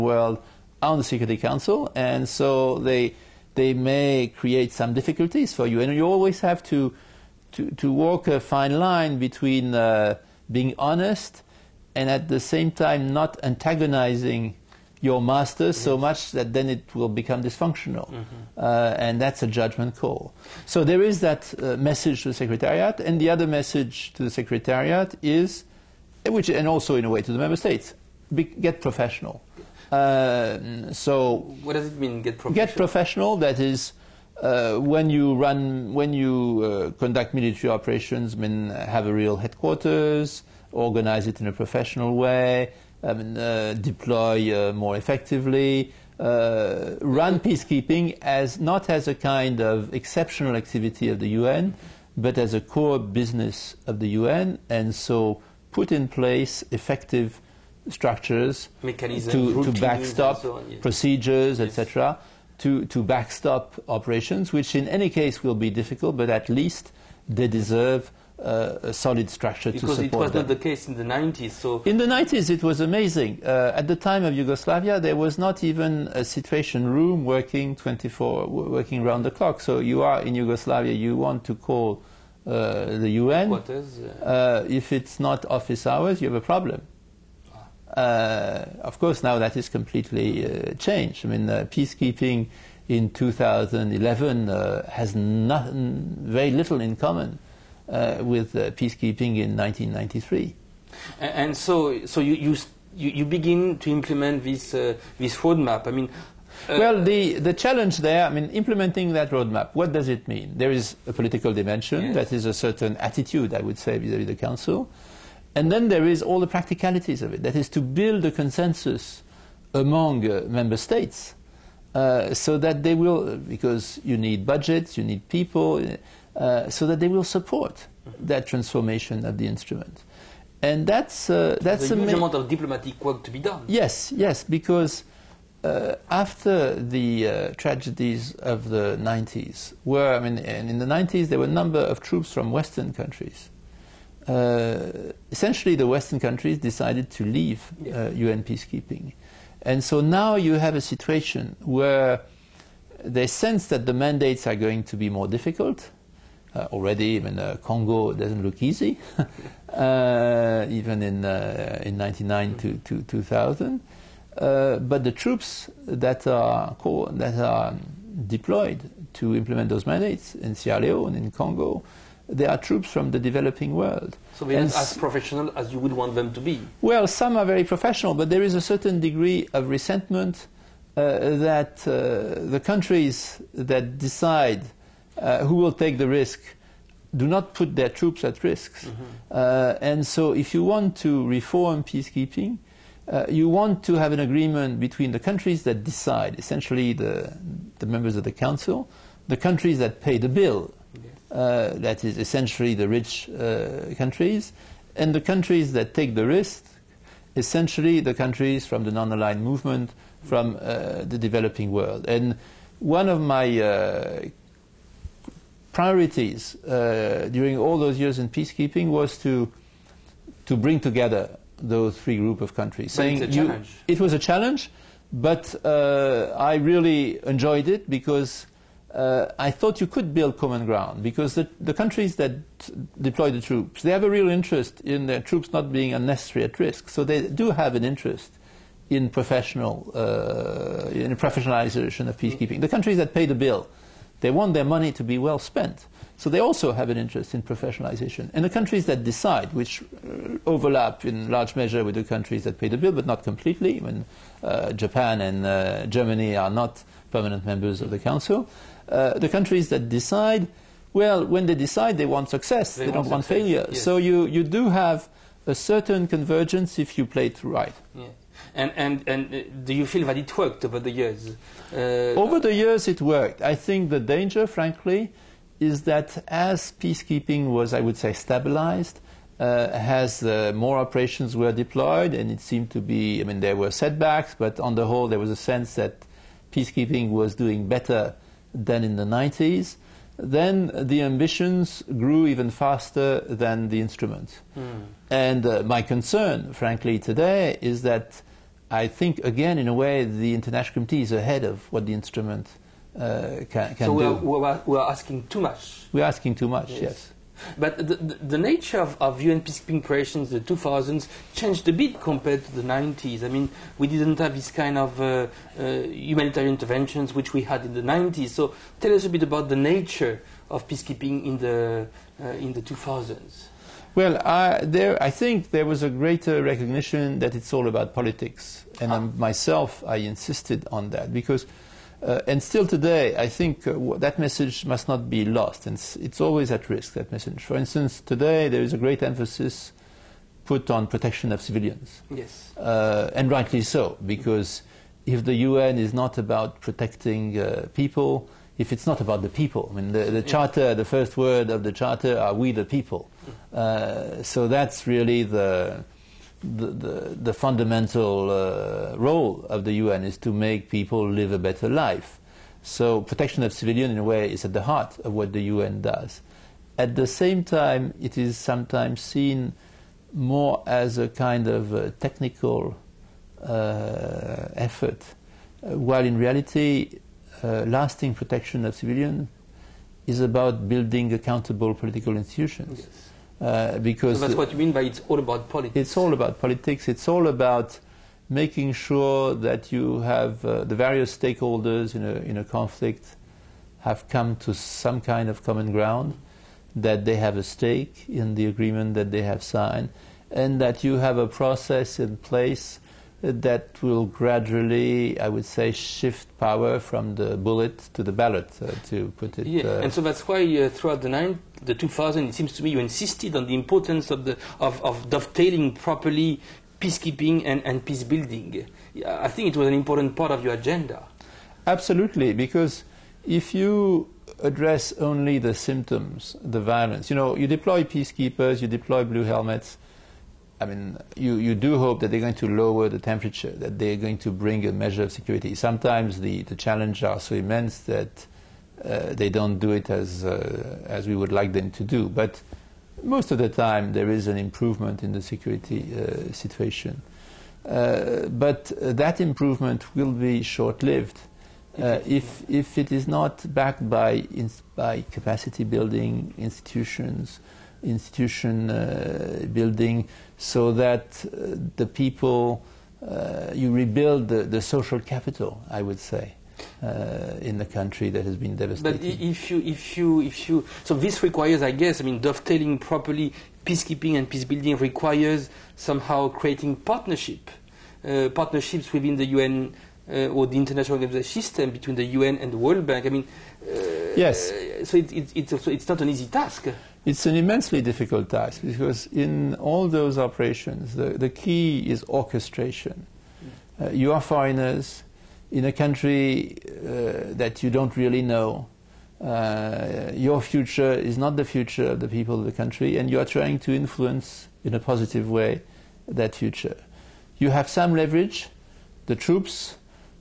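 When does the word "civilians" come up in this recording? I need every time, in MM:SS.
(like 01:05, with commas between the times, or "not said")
05:41, 06:03, 06:18.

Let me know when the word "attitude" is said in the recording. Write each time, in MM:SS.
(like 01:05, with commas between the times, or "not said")
01:52.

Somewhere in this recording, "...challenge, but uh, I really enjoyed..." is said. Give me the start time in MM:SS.
03:44.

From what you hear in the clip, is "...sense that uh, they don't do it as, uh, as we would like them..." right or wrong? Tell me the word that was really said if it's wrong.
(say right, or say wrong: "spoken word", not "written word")
wrong: "immense", not "sense".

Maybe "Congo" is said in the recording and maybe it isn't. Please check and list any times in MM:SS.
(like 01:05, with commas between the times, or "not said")
02:37, 02:51.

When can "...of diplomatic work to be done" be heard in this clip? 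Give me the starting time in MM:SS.
02:12.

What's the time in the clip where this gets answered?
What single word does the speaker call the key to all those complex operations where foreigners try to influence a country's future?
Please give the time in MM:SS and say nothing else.
08:12.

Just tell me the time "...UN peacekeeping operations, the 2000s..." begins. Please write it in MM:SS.
05:09.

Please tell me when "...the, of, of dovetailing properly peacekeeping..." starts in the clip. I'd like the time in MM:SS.
06:54.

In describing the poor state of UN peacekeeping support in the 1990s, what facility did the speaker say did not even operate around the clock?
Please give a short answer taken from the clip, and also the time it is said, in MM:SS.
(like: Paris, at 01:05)
situation room, at 01:16.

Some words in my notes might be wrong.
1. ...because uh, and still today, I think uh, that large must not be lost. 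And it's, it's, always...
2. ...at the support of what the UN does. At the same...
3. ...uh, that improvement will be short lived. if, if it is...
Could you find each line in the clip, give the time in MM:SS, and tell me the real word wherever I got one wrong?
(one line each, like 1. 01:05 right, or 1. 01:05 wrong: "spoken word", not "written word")
1. 05:31 wrong: "message", not "large"
2. 06:04 wrong: "heart", not "support"
3. 07:28 right.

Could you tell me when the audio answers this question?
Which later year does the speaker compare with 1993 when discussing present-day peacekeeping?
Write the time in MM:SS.
01:33.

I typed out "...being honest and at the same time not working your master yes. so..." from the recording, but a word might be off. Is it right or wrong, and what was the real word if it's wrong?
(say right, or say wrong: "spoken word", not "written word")
wrong: "antagonizing", not "working".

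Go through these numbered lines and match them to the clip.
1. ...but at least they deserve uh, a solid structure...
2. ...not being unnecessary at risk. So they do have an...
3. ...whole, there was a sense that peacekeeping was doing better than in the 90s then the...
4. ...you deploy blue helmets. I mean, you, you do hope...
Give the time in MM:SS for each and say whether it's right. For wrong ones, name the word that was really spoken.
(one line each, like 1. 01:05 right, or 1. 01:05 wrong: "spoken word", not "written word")
1. 01:06 right
2. 03:55 right
3. 04:44 right
4. 07:08 right.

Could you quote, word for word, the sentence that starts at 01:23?
Quarters, uh, uh, if it's not office hours, you have a problem.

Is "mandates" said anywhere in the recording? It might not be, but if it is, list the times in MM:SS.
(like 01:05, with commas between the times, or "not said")
02:33, 02:49.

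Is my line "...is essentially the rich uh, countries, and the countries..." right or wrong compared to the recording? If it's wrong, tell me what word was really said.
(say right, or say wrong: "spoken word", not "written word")
right.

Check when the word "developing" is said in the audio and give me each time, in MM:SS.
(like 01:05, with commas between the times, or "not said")
02:53, 03:31.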